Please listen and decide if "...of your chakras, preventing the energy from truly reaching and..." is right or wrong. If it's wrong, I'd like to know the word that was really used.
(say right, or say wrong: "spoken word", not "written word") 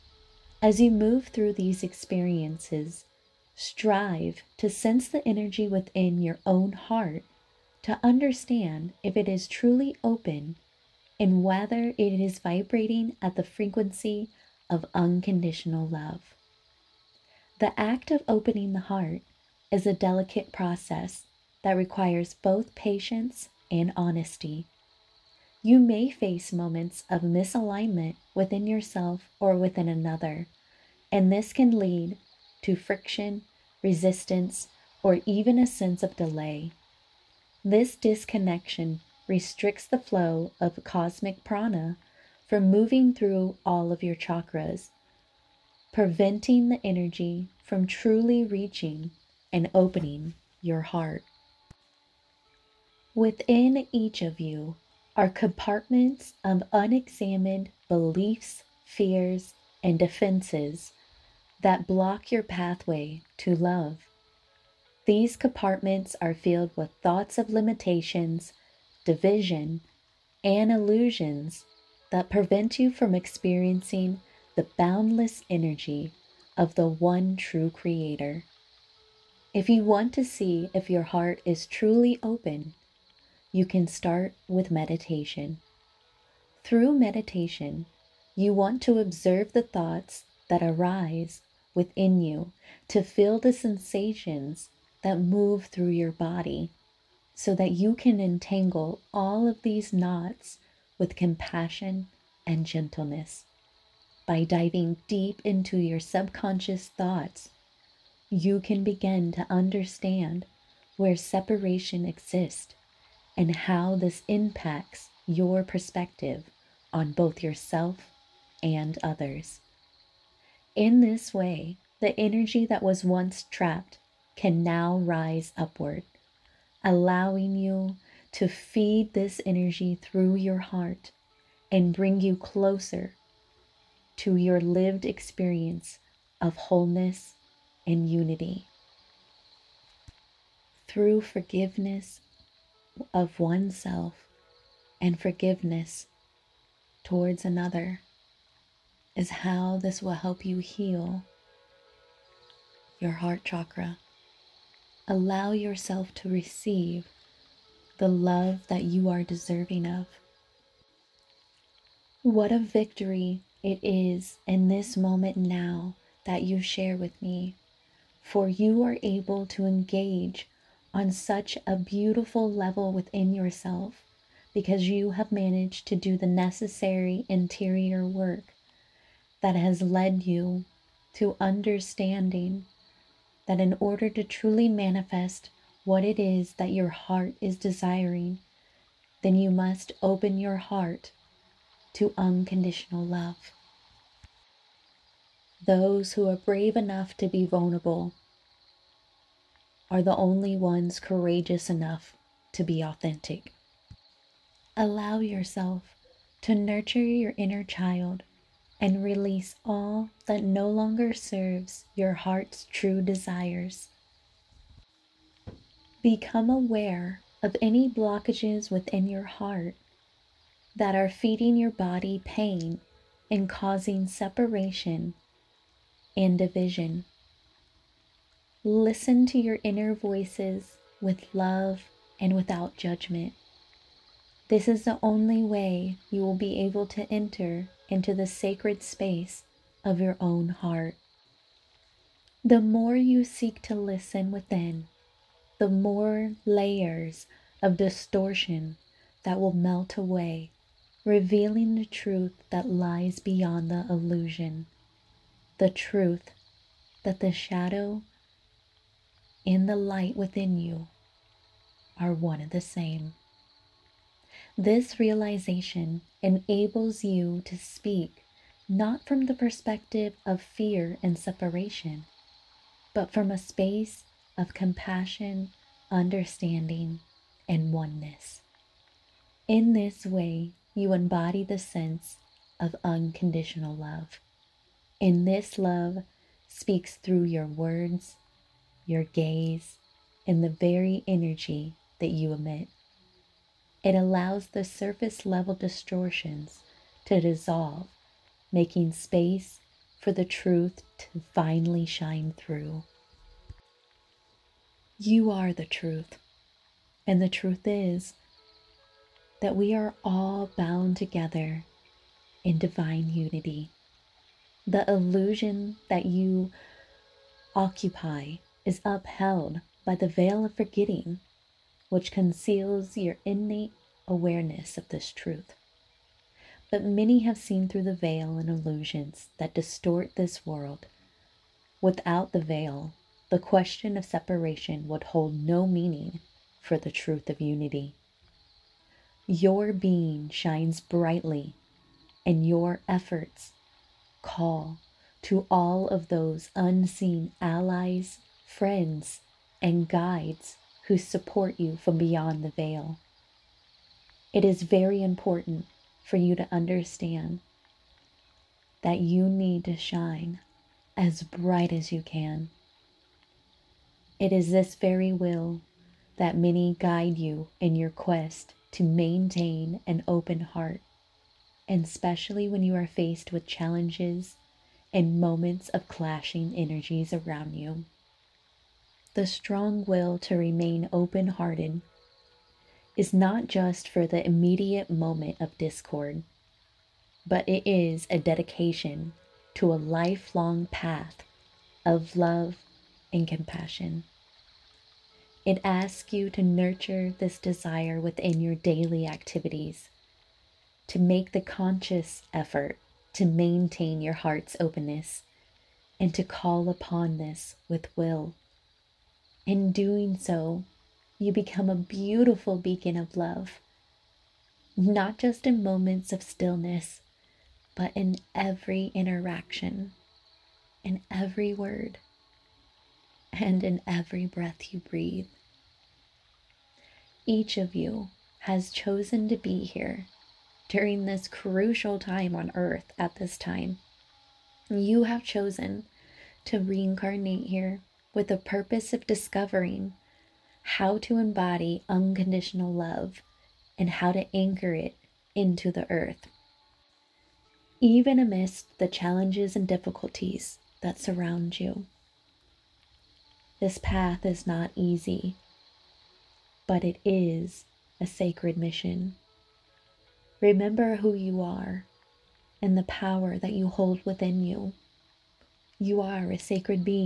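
right.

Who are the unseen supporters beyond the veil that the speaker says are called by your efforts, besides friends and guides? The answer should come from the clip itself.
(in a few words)
allies.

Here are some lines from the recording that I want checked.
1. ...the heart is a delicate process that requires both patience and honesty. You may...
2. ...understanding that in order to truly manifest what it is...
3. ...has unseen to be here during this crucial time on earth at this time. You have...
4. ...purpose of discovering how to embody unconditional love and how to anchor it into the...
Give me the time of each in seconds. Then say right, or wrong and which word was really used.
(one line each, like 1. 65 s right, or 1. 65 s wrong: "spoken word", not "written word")
1. 18 s right
2. 181 s right
3. 428 s wrong: "chosen", not "unseen"
4. 438 s right.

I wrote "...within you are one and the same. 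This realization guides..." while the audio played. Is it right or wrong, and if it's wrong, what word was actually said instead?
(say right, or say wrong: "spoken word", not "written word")
wrong: "enables", not "guides".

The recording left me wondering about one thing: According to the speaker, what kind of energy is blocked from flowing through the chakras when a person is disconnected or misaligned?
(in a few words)
cosmic prana.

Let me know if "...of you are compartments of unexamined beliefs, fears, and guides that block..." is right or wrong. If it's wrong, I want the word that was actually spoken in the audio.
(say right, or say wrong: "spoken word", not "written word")
wrong: "defenses", not "guides".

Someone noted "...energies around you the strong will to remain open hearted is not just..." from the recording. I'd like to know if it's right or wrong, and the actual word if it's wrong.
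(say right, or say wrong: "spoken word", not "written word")
right.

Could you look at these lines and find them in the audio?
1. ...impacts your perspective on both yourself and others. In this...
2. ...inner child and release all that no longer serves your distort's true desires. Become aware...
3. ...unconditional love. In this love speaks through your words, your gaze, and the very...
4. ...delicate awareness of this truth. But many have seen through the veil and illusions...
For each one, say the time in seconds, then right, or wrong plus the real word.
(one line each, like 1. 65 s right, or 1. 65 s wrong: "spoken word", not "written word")
1. 114 s right
2. 207 s wrong: "heart", not "distort"
3. 282 s right
4. 323 s wrong: "innate", not "delicate".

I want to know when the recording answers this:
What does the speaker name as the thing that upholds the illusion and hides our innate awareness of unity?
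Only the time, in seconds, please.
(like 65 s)
320 s.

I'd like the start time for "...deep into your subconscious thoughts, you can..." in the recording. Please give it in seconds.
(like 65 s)
105 s.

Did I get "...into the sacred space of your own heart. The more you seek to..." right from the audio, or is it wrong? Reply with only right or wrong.
right.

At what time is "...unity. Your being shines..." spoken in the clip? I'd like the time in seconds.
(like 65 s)
337 s.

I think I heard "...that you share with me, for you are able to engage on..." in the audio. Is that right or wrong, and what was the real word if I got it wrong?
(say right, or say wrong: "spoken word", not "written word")
right.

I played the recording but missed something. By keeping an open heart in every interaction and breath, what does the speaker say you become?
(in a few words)
beacon of love.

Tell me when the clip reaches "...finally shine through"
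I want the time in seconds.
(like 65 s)
301 s.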